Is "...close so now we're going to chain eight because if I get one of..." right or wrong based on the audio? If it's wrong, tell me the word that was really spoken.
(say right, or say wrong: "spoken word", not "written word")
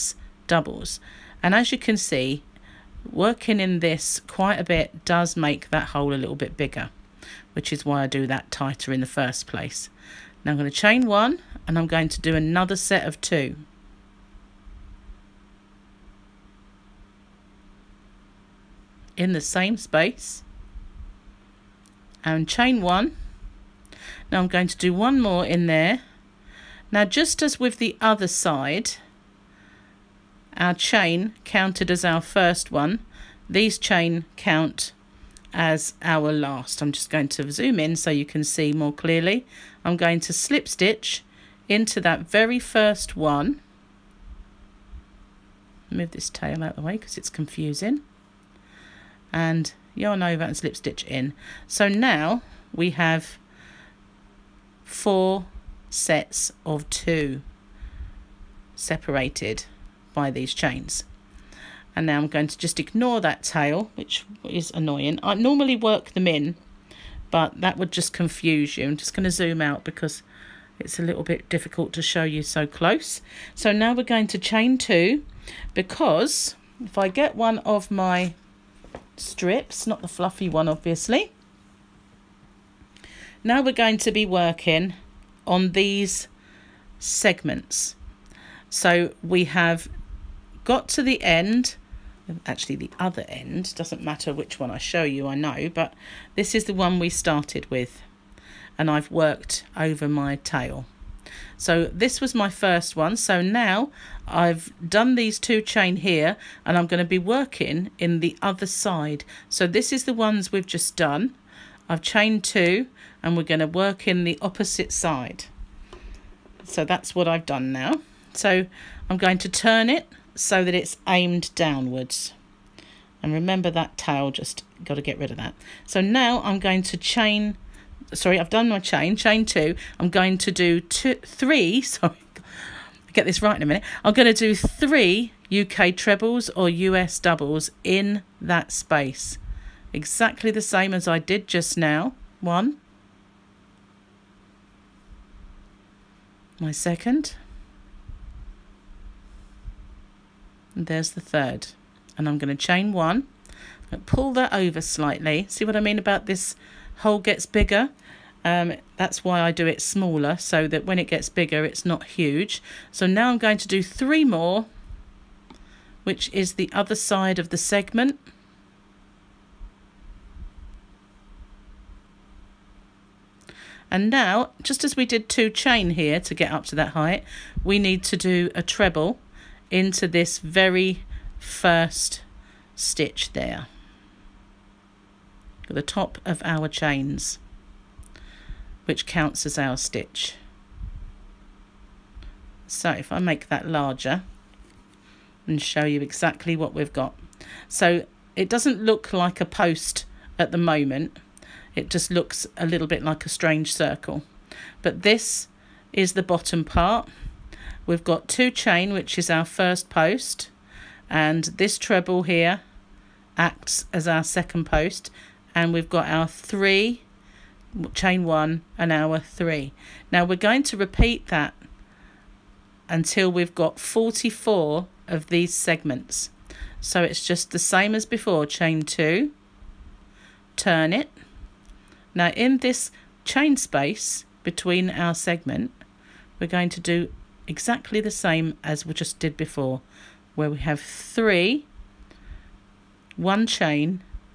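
wrong: "two", not "eight".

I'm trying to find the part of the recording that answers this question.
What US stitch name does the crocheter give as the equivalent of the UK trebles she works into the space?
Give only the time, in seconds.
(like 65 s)
136 s.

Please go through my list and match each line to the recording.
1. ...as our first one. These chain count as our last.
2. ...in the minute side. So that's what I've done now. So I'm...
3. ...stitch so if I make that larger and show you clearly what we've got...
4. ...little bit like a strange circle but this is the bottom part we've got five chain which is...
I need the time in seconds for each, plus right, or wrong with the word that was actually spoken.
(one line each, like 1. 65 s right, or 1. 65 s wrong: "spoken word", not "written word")
1. 31 s right
2. 114 s wrong: "opposite", not "minute"
3. 189 s wrong: "exactly", not "clearly"
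4. 202 s wrong: "two", not "five".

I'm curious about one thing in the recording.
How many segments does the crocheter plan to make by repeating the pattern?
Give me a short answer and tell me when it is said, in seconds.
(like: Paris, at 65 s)
44, at 223 s.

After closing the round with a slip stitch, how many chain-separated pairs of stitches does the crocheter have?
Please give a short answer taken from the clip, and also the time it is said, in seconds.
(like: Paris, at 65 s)
4, at 54 s.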